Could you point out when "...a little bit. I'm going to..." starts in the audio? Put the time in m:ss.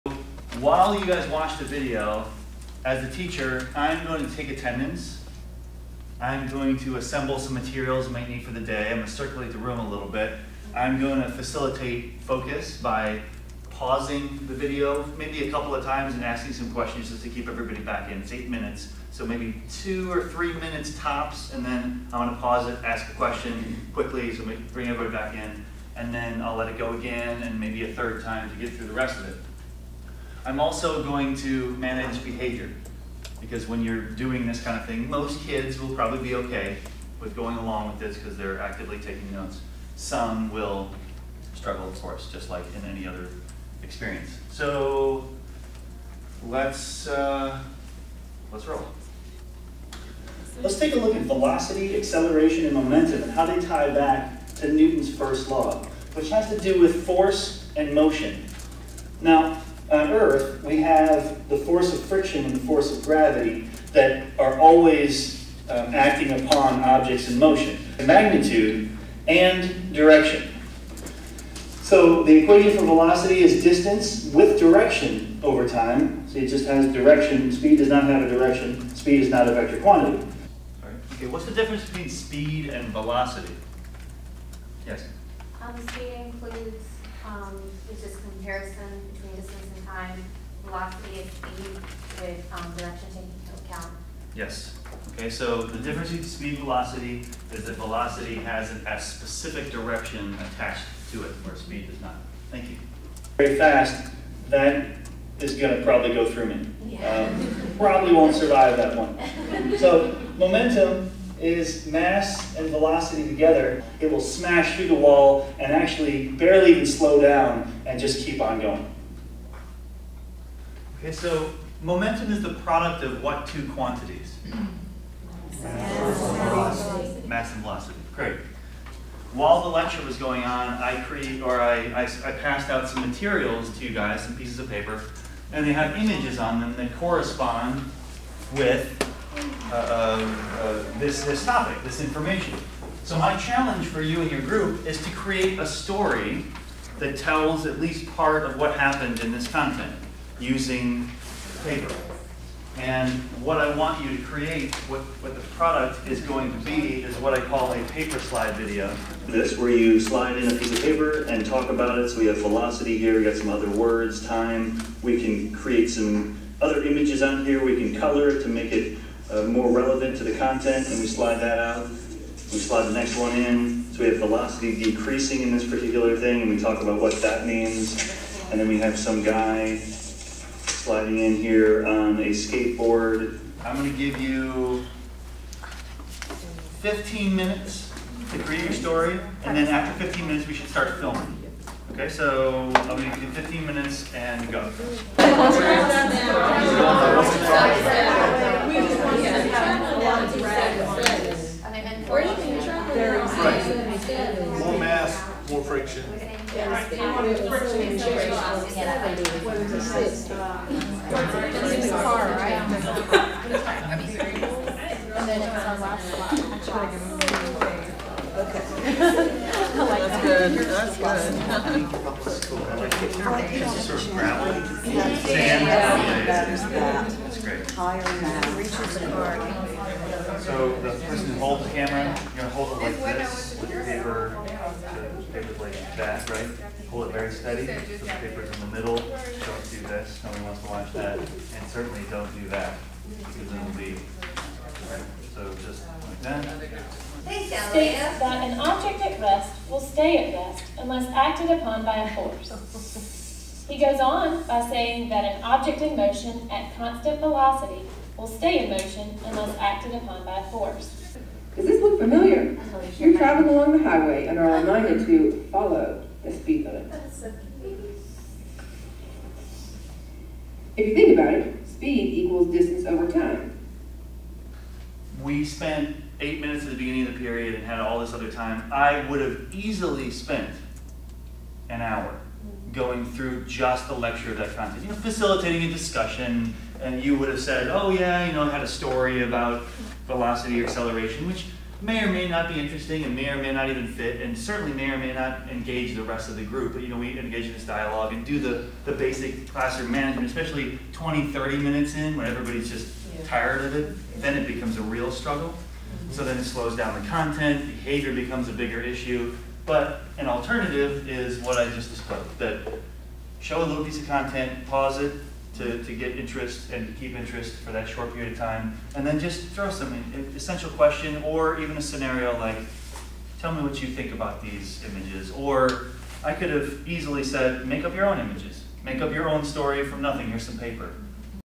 0:09.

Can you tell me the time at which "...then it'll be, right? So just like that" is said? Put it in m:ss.
4:03.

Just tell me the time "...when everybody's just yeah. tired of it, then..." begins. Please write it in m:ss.
5:02.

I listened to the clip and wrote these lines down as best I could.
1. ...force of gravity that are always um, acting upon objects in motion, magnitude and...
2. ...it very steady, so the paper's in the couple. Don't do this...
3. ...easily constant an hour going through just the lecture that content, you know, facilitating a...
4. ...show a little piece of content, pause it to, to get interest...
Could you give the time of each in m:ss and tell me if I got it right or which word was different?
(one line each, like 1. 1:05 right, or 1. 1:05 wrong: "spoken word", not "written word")
1. 1:02 right
2. 3:57 wrong: "middle", not "couple"
3. 4:39 wrong: "spent", not "constant"
4. 5:13 right.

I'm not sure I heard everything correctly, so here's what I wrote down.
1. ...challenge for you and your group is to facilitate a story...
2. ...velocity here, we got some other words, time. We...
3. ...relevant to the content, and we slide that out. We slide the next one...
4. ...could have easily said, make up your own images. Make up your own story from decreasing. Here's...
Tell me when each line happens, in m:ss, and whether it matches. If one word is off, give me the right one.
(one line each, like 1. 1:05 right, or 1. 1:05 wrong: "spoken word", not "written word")
1. 2:23 wrong: "create", not "facilitate"
2. 2:42 right
3. 2:49 right
4. 5:26 wrong: "nothing", not "decreasing".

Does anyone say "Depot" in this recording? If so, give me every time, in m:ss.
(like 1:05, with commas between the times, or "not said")
not said.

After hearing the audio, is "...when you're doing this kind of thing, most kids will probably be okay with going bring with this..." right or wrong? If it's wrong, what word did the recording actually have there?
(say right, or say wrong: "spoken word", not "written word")
wrong: "along", not "bring".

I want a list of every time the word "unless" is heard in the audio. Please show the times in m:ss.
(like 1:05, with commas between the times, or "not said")
4:10, 4:19.